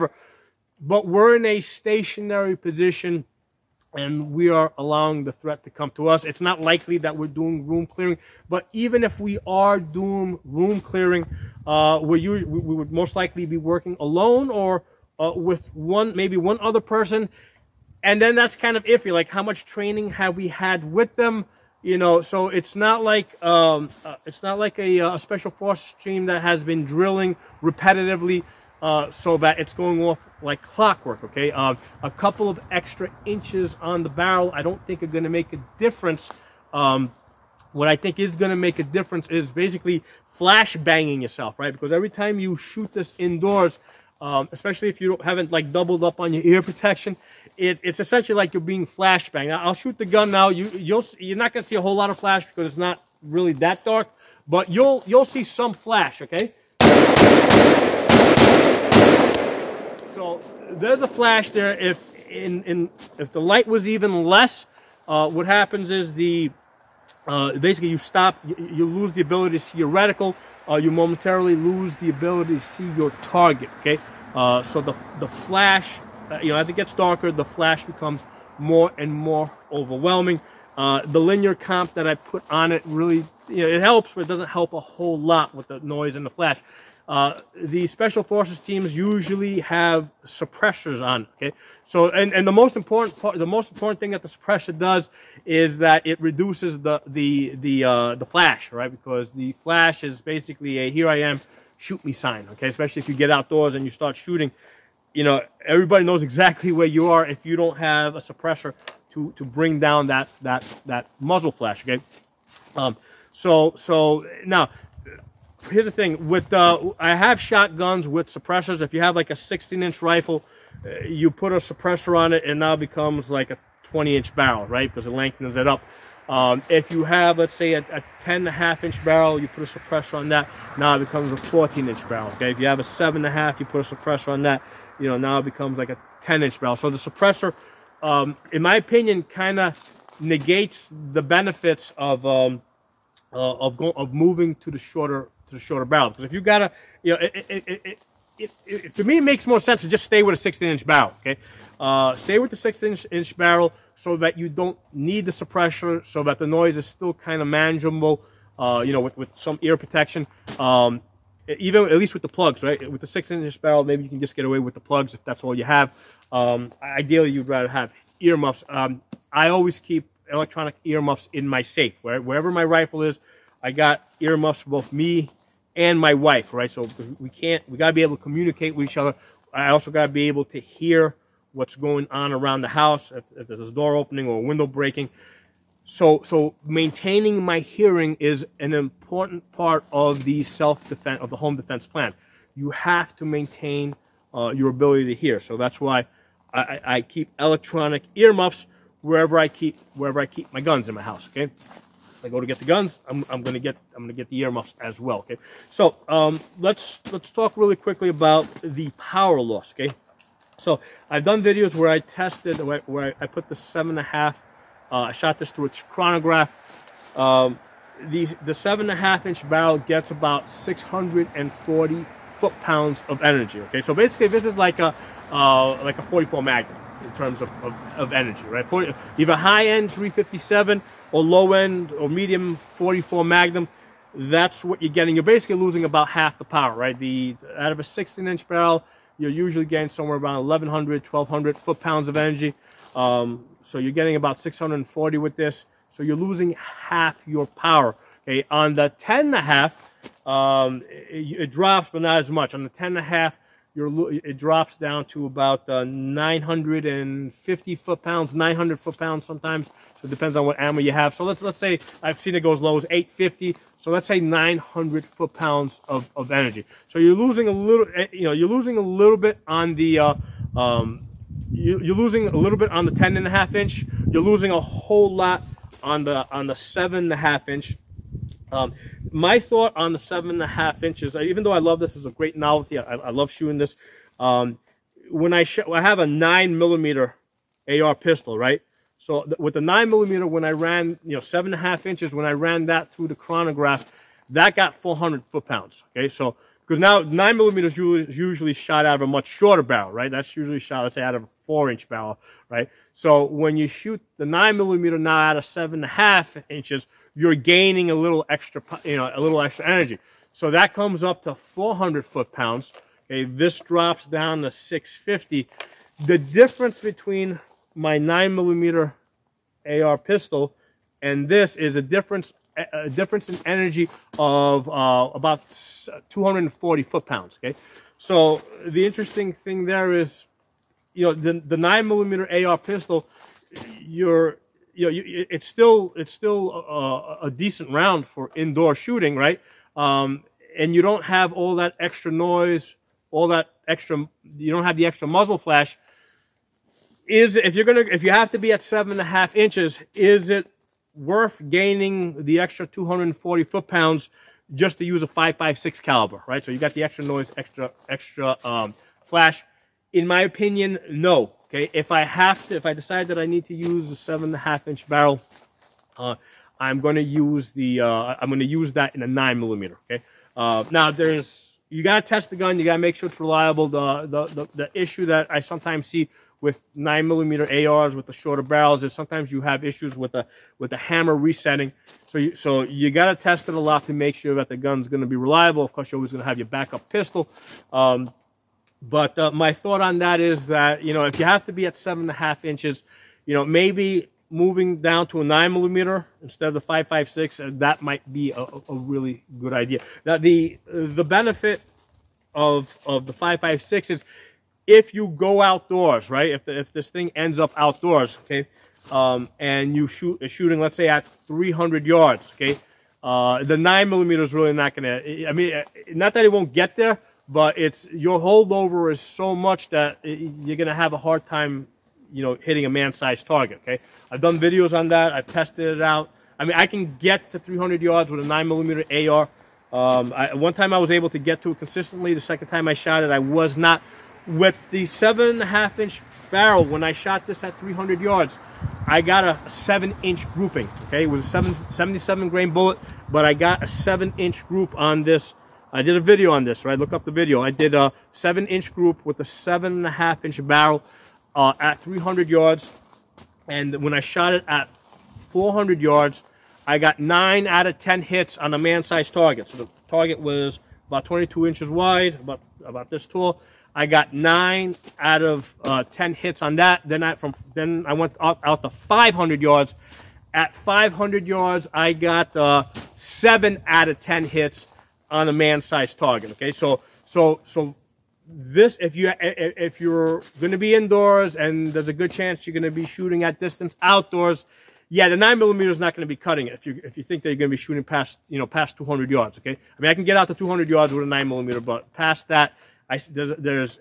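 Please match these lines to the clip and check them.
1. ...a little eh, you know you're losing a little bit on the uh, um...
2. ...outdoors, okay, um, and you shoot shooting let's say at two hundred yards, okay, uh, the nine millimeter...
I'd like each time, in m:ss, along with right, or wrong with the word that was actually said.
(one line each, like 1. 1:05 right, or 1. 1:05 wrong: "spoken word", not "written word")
1. 4:27 right
2. 6:47 wrong: "three", not "two".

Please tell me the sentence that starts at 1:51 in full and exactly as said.
Okay, um, so so now here's the thing with uh, I have shotguns with suppressors.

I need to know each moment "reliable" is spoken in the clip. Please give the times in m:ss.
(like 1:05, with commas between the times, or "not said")
6:13, 6:25.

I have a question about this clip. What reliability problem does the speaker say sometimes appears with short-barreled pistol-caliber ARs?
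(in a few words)
hammer resetting.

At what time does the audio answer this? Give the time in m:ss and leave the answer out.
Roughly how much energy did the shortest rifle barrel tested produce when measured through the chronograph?
3:40.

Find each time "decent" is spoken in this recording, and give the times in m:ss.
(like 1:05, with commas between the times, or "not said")
5:37.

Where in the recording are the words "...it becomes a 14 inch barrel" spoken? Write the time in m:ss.
2:10.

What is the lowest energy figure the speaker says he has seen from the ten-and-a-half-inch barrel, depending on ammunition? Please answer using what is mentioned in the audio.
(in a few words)
850.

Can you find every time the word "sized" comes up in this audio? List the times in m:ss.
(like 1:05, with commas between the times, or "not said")
7:02, 7:38, 7:55.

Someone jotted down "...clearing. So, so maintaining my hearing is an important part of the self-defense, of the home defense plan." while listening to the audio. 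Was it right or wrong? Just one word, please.
wrong.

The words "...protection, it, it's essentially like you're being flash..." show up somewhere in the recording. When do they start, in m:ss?
0:46.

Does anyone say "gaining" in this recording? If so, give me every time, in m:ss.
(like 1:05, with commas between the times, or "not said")
5:07, 5:51.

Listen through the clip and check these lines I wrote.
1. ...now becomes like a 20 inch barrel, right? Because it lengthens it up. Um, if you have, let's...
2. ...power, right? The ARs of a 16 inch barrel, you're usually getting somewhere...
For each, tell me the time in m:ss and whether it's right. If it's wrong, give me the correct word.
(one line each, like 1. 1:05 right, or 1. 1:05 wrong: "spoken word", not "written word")
1. 2:02 right
2. 3:56 wrong: "Out", not "ARs".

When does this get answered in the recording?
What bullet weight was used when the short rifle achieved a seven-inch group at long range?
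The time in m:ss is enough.
7:21.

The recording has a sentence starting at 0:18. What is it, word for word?
And then that's kind of iffy, like how much training have we had with them?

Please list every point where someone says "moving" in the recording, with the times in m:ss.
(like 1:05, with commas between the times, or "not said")
2:24, 6:34.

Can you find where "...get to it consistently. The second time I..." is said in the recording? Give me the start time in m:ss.
7:11.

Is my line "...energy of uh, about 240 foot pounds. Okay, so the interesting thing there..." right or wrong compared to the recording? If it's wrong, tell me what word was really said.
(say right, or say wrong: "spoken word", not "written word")
right.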